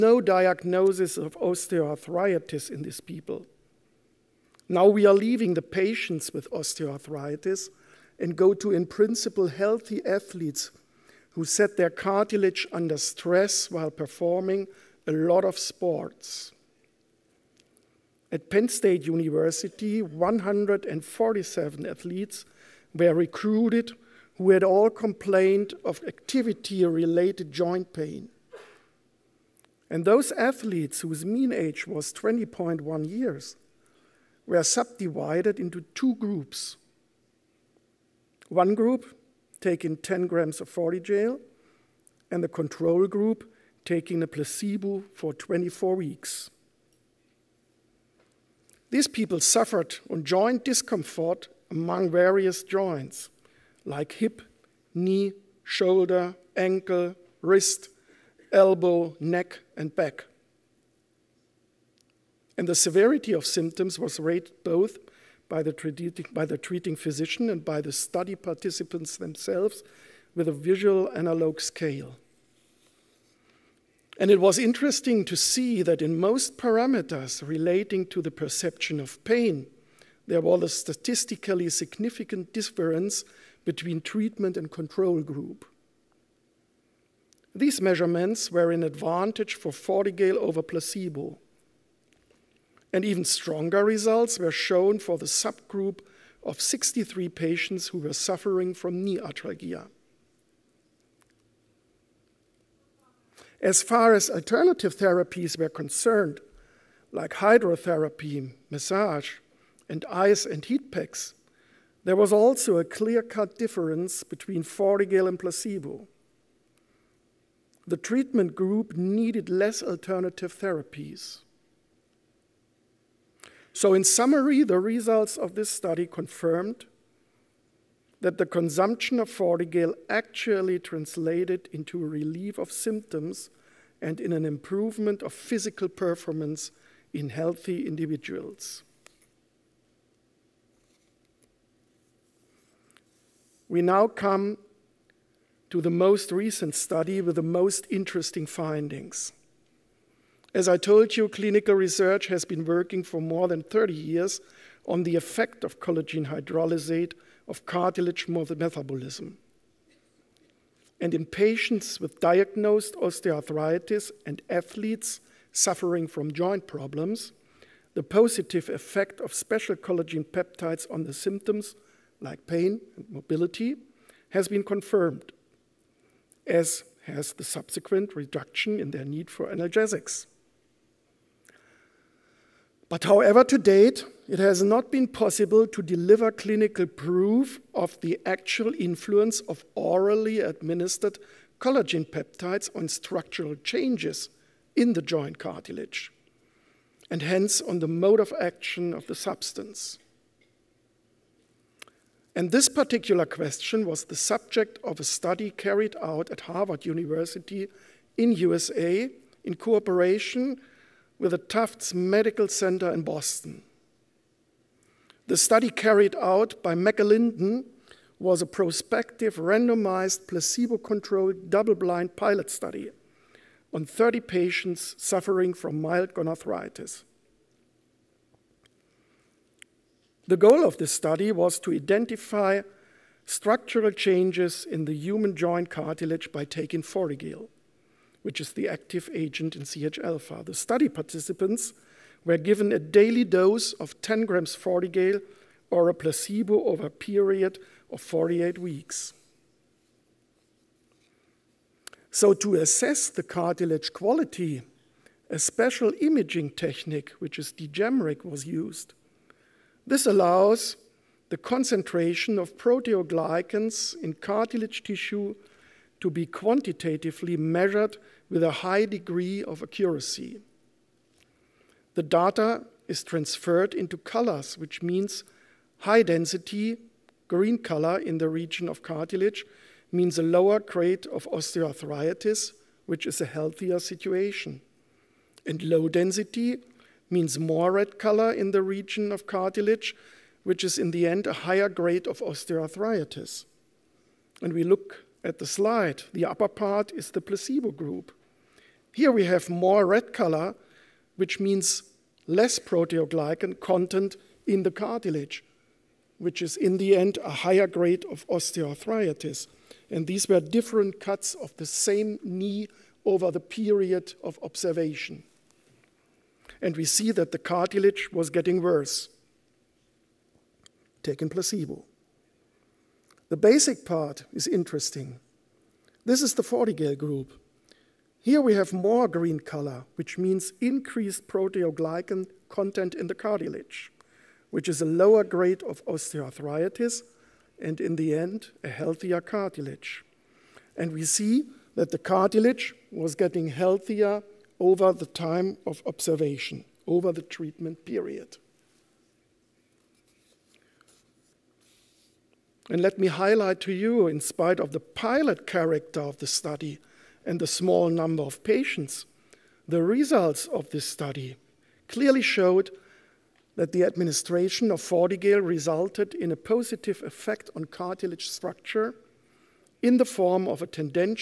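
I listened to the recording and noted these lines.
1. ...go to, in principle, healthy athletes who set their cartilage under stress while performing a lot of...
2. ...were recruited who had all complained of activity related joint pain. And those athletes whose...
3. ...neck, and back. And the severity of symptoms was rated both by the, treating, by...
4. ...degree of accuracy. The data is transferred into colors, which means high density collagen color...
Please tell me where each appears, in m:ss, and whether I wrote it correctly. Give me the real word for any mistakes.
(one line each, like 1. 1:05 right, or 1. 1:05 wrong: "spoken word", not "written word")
1. 0:08 right
2. 0:22 right
3. 0:59 right
4. 4:28 wrong: "green", not "collagen".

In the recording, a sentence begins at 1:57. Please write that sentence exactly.
The treatment group needed less alternative therapies.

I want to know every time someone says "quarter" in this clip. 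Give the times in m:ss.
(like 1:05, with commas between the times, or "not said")
not said.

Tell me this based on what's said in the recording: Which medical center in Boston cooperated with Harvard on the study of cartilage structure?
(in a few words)
Tufts Medical Center.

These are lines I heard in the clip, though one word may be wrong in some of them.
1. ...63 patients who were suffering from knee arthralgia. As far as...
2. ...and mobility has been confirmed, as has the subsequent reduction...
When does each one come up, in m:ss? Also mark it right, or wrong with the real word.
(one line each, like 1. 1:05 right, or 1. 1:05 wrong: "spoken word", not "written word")
1. 1:36 right
2. 2:52 right.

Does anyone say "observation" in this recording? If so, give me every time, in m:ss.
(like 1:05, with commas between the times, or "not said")
5:14, 5:45.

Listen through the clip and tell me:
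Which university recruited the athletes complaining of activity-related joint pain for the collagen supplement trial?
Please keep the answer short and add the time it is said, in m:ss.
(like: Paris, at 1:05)
Penn State University, at 0:18.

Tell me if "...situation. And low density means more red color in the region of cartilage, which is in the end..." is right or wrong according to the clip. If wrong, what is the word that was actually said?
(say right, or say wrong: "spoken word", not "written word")
right.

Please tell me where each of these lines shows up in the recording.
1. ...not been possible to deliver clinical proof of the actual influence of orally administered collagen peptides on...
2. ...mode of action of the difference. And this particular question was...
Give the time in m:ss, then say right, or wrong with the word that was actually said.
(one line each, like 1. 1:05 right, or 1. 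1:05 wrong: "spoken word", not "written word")
1. 3:04 right
2. 3:17 wrong: "substance", not "difference".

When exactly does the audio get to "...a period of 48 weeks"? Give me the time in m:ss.
4:06.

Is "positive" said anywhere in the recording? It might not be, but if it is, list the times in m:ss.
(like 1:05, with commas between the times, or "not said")
2:48, 6:06.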